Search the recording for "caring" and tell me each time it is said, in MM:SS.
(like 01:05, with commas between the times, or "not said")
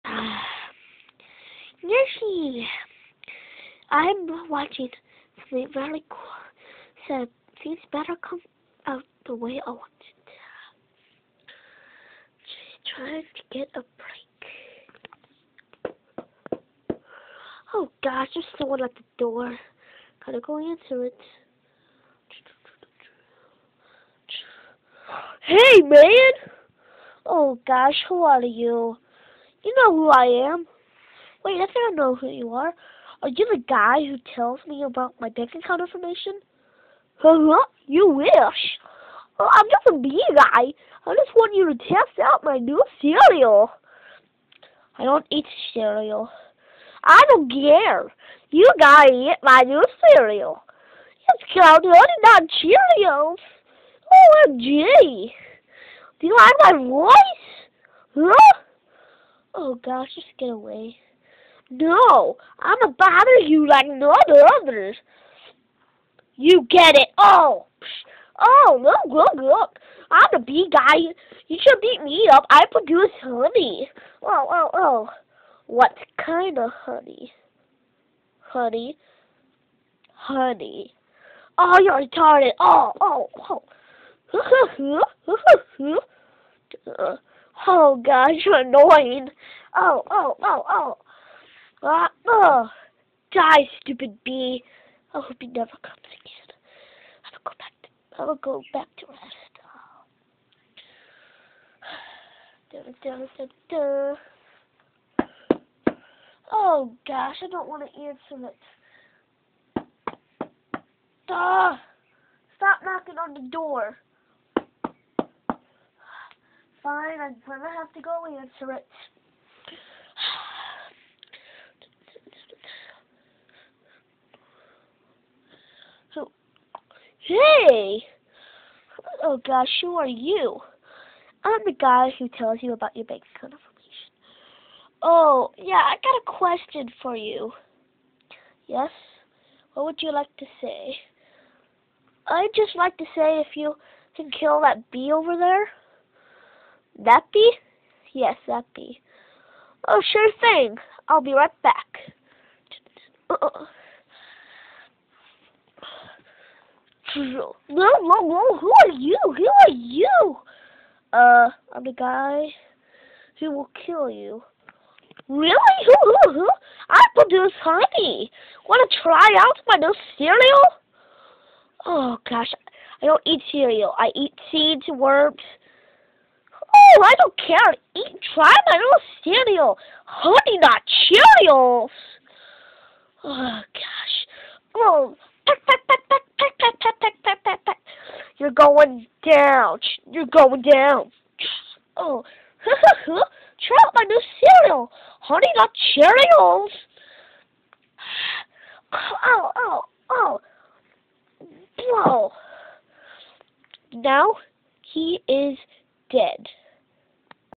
not said.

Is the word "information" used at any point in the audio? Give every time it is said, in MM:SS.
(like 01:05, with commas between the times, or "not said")
00:35, 02:13.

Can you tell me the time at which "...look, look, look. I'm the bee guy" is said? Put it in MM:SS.
01:08.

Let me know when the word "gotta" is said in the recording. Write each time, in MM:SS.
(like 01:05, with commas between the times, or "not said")
00:20, 00:48.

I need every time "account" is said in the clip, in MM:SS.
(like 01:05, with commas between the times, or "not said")
00:35, 02:13.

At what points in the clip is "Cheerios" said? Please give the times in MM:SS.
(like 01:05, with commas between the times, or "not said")
00:52, 03:00, 03:15.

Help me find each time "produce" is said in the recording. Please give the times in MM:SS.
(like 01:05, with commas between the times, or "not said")
01:12, 02:47.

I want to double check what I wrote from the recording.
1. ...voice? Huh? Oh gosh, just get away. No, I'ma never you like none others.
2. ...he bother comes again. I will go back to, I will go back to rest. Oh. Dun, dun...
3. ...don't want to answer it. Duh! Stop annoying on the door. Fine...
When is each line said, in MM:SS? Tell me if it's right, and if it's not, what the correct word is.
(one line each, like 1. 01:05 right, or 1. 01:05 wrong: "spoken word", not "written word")
1. 00:56 wrong: "bother", not "never"
2. 01:35 wrong: "never", not "bother"
3. 01:47 wrong: "knocking", not "annoying".